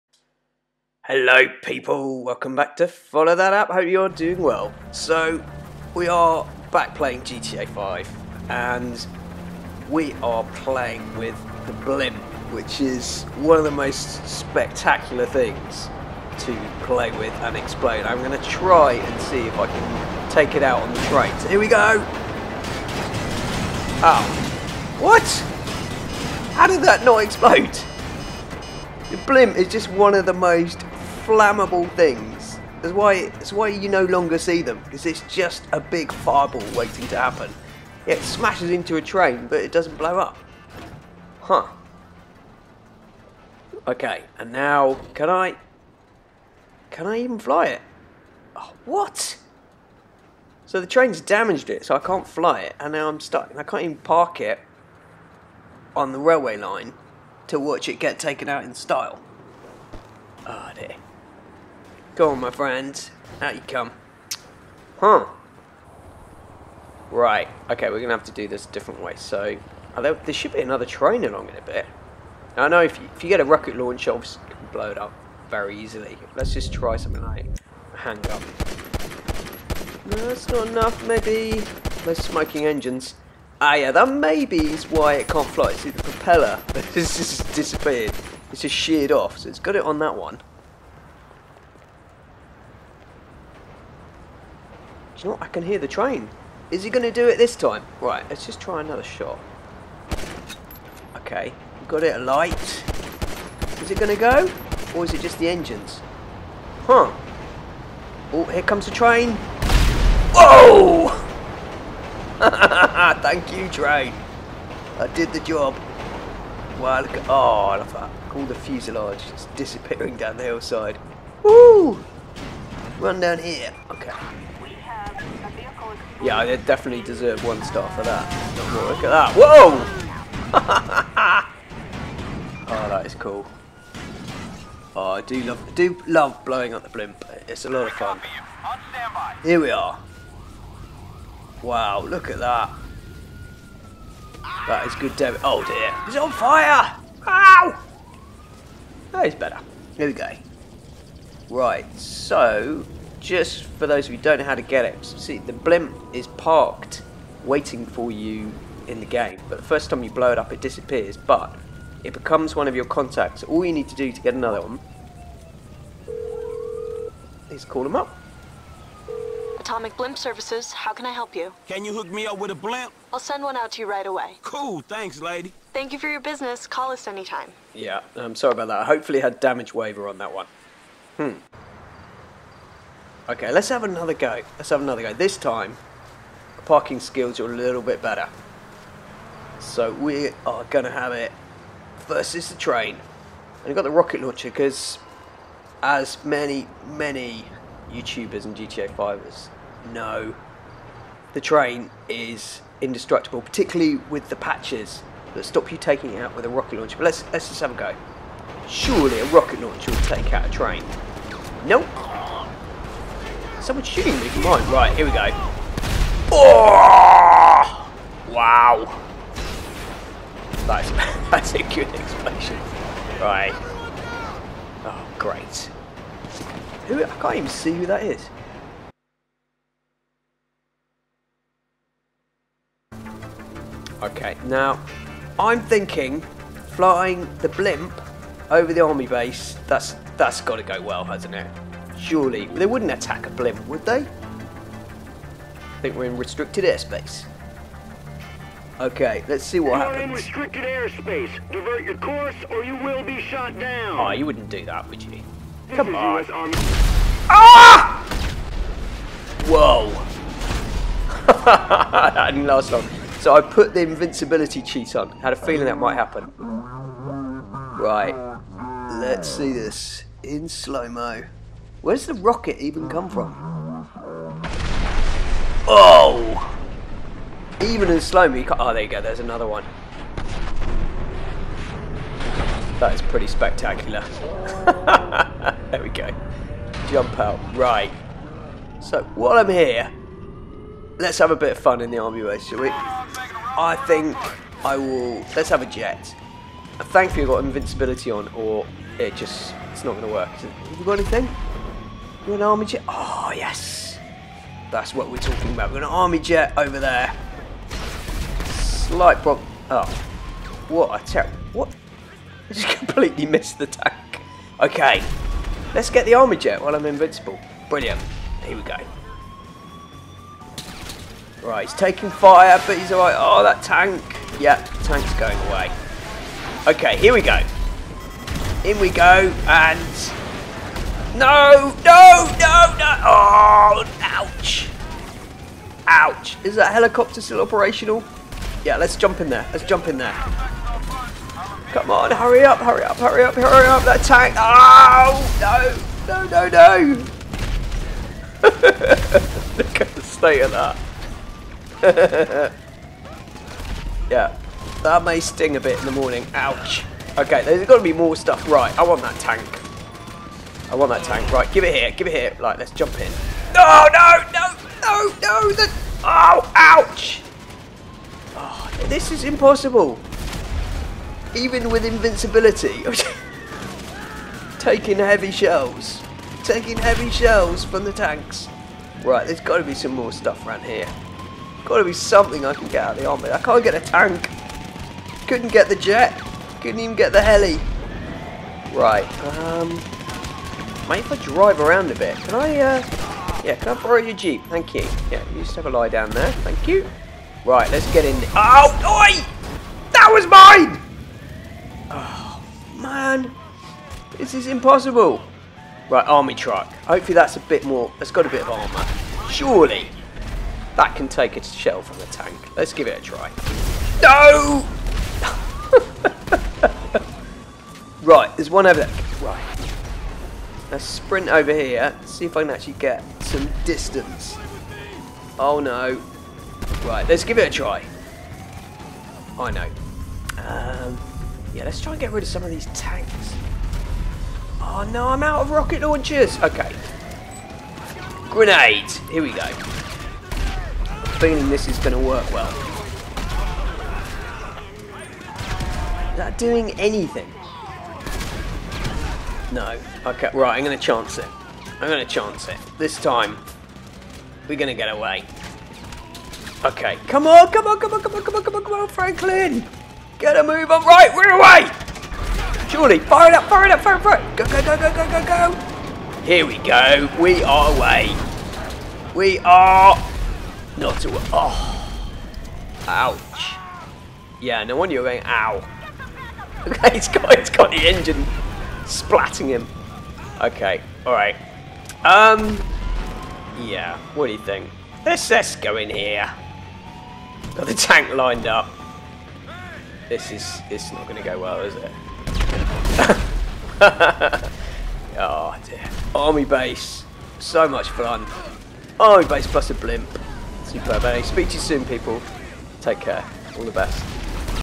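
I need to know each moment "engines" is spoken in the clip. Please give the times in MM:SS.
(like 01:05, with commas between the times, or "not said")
01:22, 01:45, 07:57.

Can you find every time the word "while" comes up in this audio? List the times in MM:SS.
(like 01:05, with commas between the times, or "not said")
04:49, 05:16.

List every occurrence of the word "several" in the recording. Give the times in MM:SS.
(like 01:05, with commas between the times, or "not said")
not said.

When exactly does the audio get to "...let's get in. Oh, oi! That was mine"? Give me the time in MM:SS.
06:37.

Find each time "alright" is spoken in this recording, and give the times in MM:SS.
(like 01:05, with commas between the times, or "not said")
05:22, 08:01.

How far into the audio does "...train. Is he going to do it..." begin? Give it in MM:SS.
01:35.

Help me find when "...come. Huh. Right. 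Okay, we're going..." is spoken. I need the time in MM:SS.
01:03.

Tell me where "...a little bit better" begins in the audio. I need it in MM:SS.
03:07.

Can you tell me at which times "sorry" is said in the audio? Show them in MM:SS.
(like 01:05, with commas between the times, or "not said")
02:58.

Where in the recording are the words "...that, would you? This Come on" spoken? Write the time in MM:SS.
04:14.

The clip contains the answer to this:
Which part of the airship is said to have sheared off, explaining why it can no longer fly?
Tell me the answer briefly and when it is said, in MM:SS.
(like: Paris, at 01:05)
the propeller, at 01:26.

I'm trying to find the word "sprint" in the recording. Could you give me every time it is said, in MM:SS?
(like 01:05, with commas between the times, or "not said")
07:00.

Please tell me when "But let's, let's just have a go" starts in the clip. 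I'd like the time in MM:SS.
03:26.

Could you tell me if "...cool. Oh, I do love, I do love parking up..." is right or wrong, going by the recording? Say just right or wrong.
wrong.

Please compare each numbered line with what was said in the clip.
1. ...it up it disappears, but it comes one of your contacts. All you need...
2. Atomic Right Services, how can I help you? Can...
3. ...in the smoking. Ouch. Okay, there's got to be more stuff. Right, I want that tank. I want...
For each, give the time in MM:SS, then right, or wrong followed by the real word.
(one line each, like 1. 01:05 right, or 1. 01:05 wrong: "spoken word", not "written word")
1. 02:40 wrong: "becomes", not "comes"
2. 02:49 wrong: "Blimp", not "Right"
3. 05:55 wrong: "morning", not "smoking".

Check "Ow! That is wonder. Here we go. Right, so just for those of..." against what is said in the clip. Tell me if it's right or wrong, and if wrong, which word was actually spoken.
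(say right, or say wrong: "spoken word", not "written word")
wrong: "better", not "wonder".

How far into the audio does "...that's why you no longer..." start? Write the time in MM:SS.
00:33.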